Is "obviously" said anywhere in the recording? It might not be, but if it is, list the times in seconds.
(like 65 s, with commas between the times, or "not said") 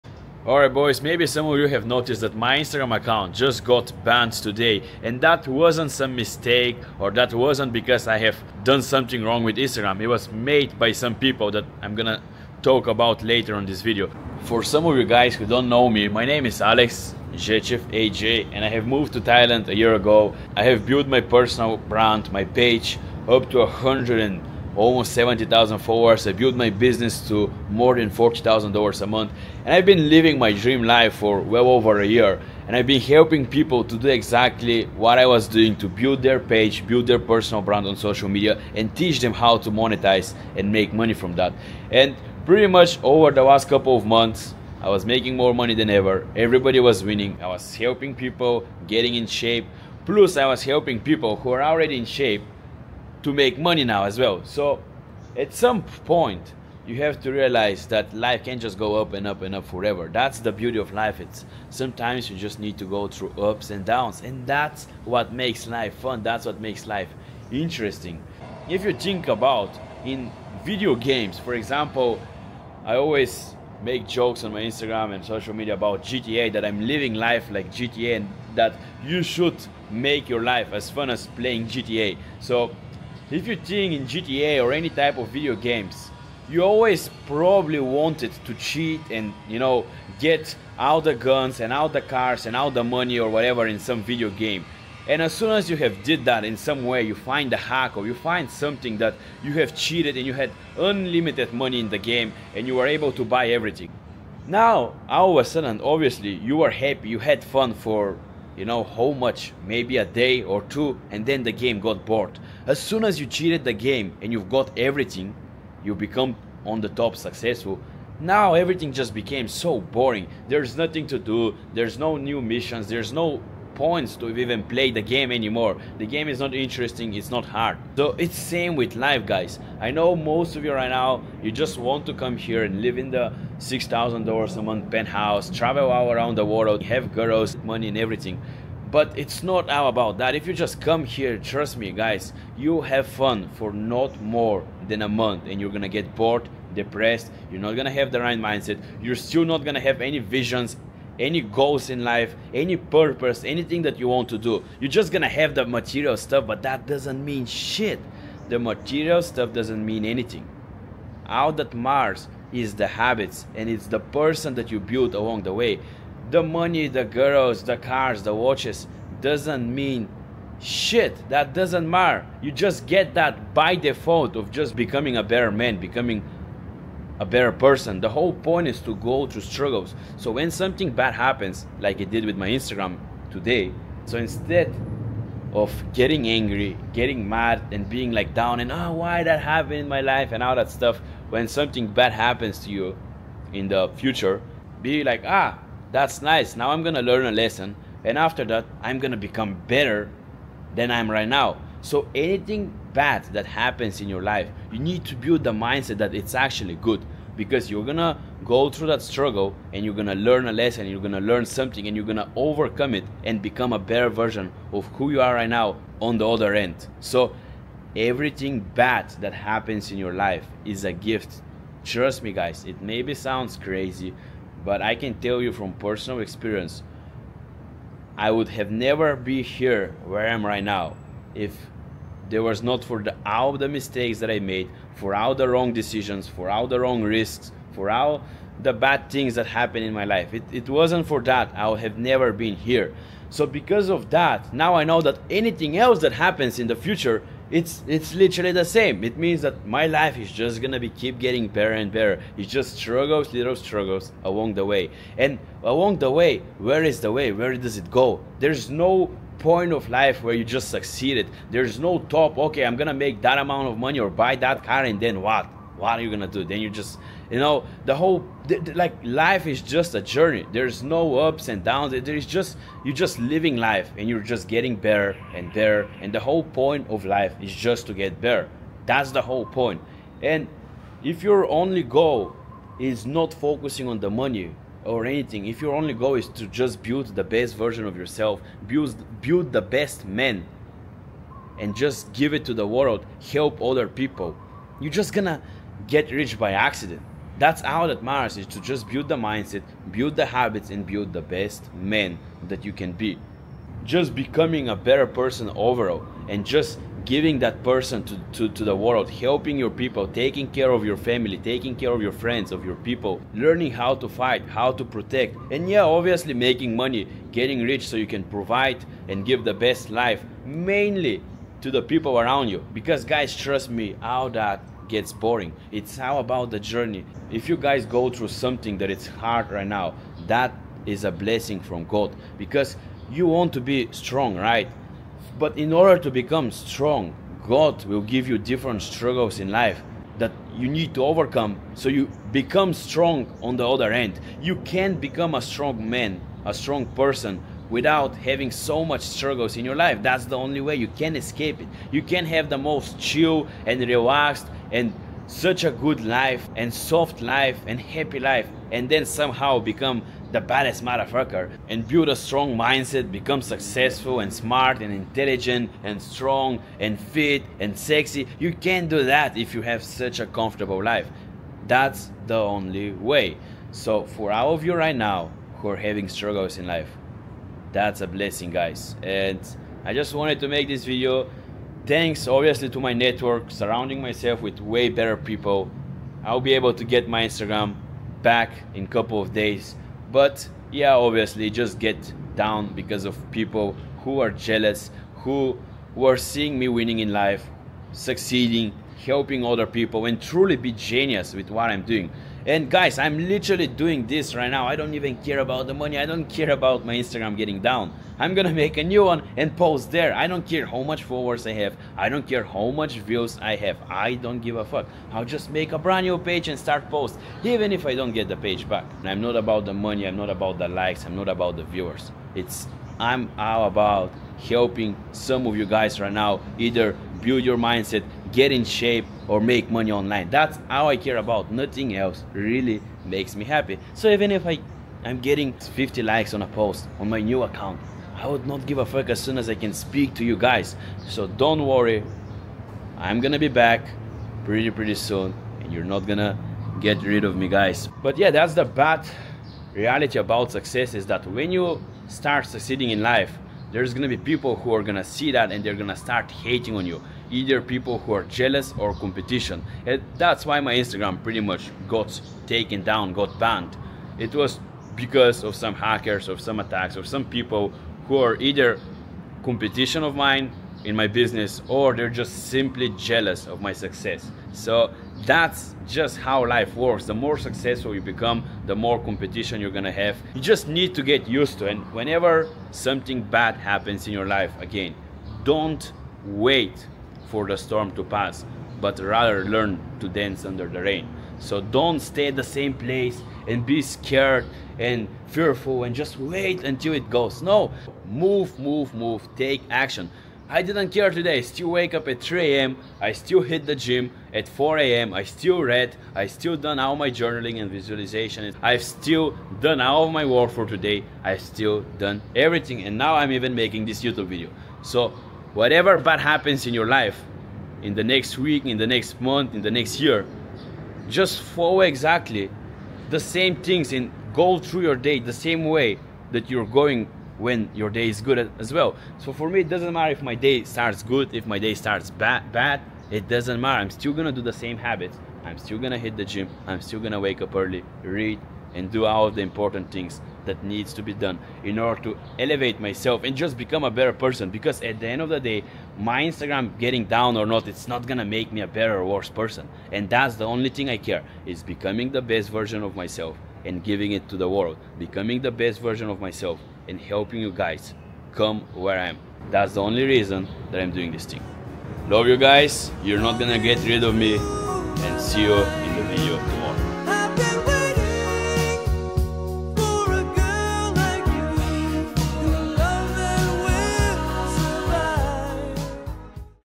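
105 s, 315 s, 382 s, 390 s.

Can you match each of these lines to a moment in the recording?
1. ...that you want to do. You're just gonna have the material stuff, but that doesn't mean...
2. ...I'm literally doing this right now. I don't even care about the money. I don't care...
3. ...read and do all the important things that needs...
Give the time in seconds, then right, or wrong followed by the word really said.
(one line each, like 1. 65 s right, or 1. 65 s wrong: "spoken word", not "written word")
1. 153 s right
2. 402 s right
3. 538 s right.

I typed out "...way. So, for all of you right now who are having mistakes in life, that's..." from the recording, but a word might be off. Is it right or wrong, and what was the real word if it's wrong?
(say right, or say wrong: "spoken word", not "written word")
wrong: "struggles", not "mistakes".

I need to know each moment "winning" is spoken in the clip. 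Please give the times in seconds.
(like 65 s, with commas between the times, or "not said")
47 s, 396 s.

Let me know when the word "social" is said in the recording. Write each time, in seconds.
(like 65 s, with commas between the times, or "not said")
37 s, 75 s.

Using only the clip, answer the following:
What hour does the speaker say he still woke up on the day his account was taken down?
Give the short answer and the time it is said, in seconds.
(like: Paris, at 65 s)
3 a.m., at 502 s.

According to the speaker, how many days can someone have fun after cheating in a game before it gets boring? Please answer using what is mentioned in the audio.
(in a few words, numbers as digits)
a day or two.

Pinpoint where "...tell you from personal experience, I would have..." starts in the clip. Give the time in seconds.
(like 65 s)
225 s.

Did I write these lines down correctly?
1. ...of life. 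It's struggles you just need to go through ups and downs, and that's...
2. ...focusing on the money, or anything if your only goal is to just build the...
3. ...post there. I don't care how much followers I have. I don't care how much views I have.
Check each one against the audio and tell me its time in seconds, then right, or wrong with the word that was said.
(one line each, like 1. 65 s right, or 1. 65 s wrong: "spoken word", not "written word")
1. 60 s wrong: "sometimes", not "struggles"
2. 283 s right
3. 409 s right.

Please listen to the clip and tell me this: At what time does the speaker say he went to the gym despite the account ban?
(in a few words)
4 a.m.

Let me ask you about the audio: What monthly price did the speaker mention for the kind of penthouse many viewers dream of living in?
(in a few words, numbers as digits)
$6,000.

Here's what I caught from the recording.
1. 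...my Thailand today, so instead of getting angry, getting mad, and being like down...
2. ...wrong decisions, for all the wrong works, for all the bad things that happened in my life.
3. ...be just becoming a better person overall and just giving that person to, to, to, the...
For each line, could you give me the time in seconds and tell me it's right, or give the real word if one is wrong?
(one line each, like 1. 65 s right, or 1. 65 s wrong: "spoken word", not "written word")
1. 182 s wrong: "Instagram", not "Thailand"
2. 235 s wrong: "risks", not "works"
3. 302 s right.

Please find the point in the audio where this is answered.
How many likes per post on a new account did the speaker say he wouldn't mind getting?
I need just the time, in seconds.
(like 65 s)
435 s.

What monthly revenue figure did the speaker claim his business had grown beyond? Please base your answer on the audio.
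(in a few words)
$40,000.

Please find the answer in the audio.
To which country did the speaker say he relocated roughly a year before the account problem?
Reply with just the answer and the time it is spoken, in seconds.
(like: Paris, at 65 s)
Thailand, at 19 s.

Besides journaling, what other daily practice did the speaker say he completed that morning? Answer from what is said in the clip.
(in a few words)
visualization.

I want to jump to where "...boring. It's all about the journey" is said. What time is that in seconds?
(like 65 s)
325 s.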